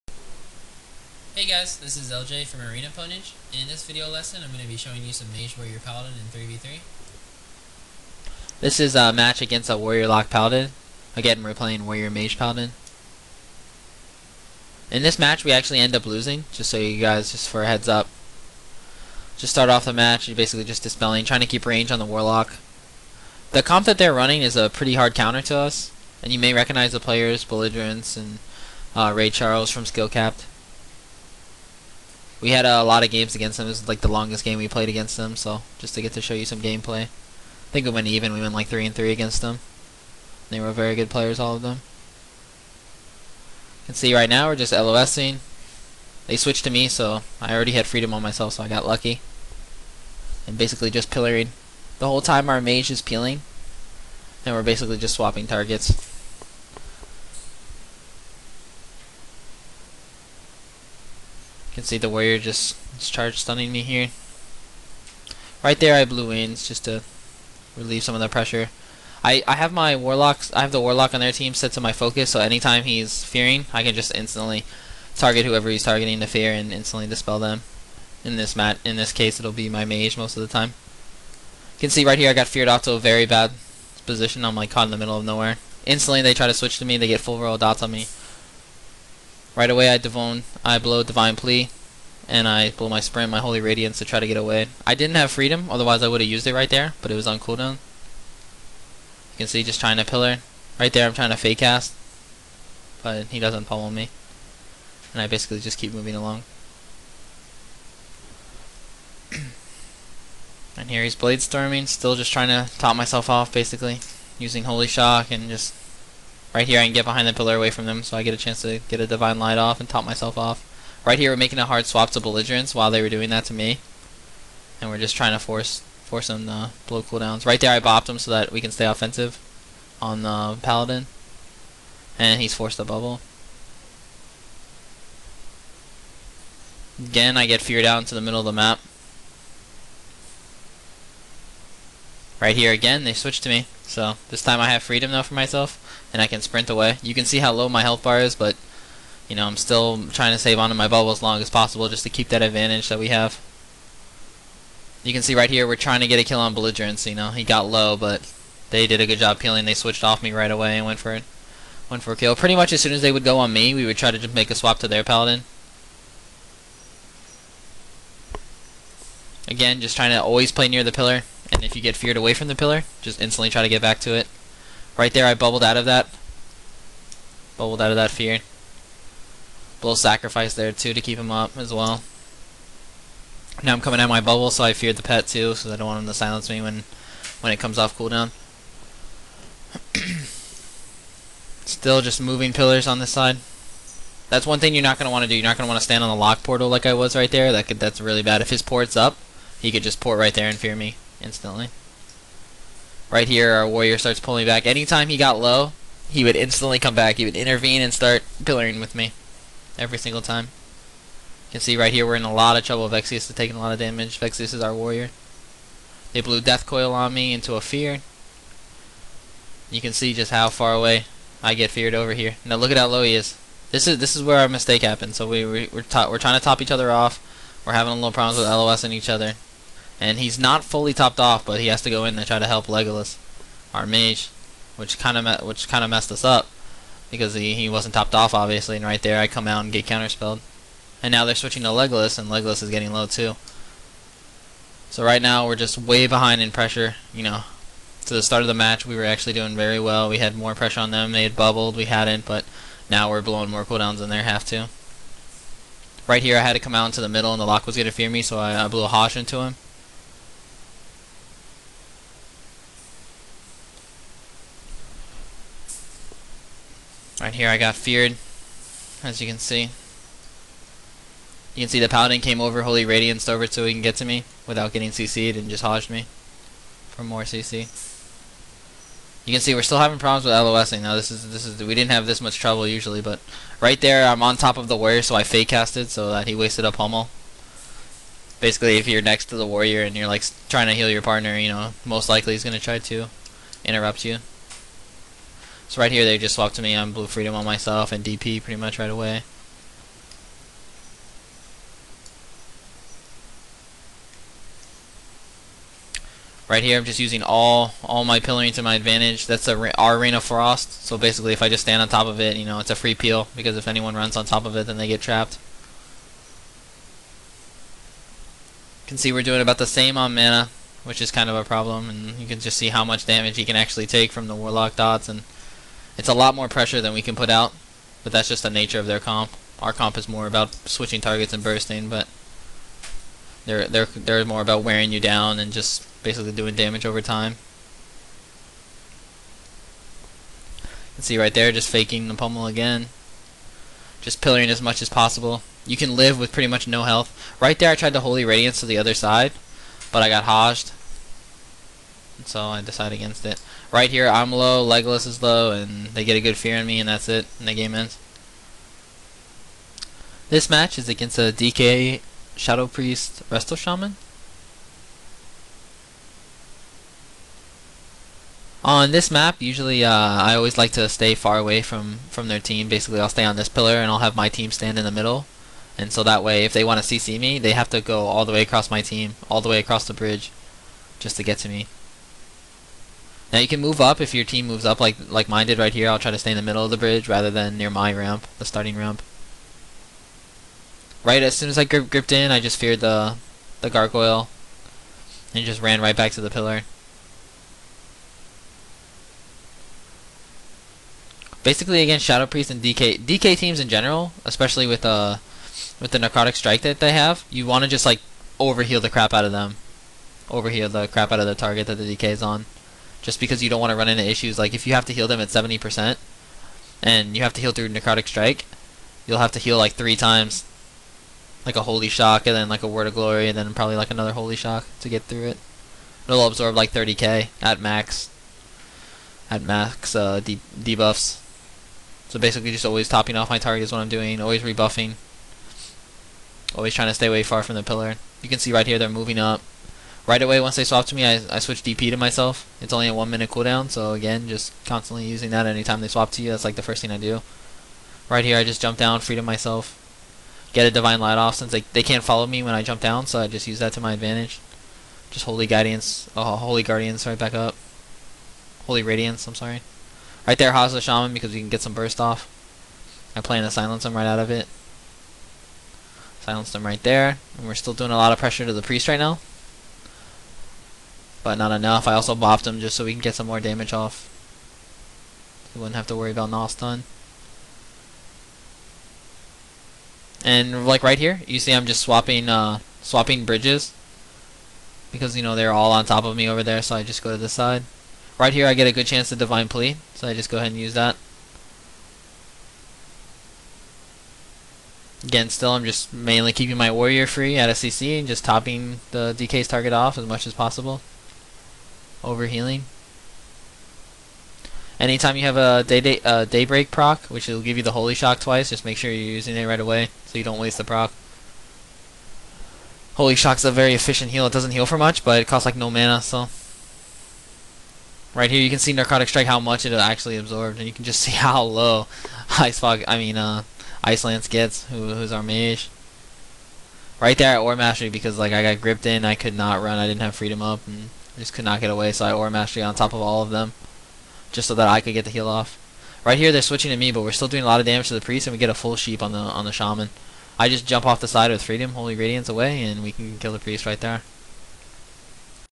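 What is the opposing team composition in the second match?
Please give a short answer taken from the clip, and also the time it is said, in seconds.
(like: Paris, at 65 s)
DK Shadow Priest Resto Shaman, at 361 s.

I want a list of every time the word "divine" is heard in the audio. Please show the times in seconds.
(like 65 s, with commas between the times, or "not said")
91 s, 119 s, 450 s, 489 s.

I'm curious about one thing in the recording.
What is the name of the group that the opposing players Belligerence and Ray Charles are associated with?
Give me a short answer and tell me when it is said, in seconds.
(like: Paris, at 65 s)
Skill Capped, at 29 s.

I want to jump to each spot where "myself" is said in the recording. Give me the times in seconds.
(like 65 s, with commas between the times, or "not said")
48 s, 112 s, 120 s, 145 s, 297 s, 441 s, 449 s.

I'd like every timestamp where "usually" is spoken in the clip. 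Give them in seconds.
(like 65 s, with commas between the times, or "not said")
282 s, 369 s.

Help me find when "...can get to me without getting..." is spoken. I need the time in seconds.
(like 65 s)
273 s.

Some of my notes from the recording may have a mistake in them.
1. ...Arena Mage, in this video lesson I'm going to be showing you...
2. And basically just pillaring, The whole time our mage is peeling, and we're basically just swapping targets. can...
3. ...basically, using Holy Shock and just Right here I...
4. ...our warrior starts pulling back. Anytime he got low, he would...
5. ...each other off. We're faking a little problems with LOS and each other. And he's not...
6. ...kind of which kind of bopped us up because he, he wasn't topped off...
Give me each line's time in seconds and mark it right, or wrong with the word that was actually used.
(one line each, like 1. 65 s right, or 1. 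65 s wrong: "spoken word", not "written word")
1. 2 s wrong: "Ponage", not "Mage"
2. 50 s right
3. 113 s right
4. 203 s right
5. 226 s wrong: "having", not "faking"
6. 234 s wrong: "messed", not "bopped".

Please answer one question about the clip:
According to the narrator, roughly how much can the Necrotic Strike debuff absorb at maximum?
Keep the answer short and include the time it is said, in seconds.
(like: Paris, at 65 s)
30k, at 426 s.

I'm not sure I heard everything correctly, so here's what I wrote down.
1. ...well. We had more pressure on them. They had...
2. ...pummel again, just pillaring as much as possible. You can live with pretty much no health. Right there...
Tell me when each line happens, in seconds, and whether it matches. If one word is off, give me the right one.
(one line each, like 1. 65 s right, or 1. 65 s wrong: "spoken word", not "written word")
1. 249 s right
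2. 342 s right.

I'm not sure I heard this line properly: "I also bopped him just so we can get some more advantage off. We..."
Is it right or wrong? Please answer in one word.
wrong.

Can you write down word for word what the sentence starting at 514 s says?
It doesn't heal for much, but it costs like no mana, so.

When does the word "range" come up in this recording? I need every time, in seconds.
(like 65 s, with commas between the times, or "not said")
21 s.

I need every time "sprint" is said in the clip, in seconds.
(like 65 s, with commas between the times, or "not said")
93 s, 146 s.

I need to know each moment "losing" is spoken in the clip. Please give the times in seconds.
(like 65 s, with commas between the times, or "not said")
16 s, 44 s, 280 s.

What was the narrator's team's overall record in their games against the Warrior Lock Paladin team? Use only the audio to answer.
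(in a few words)
3 and 3.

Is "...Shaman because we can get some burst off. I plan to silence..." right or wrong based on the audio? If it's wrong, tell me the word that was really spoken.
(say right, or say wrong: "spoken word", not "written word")
right.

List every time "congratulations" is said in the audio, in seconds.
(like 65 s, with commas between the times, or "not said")
not said.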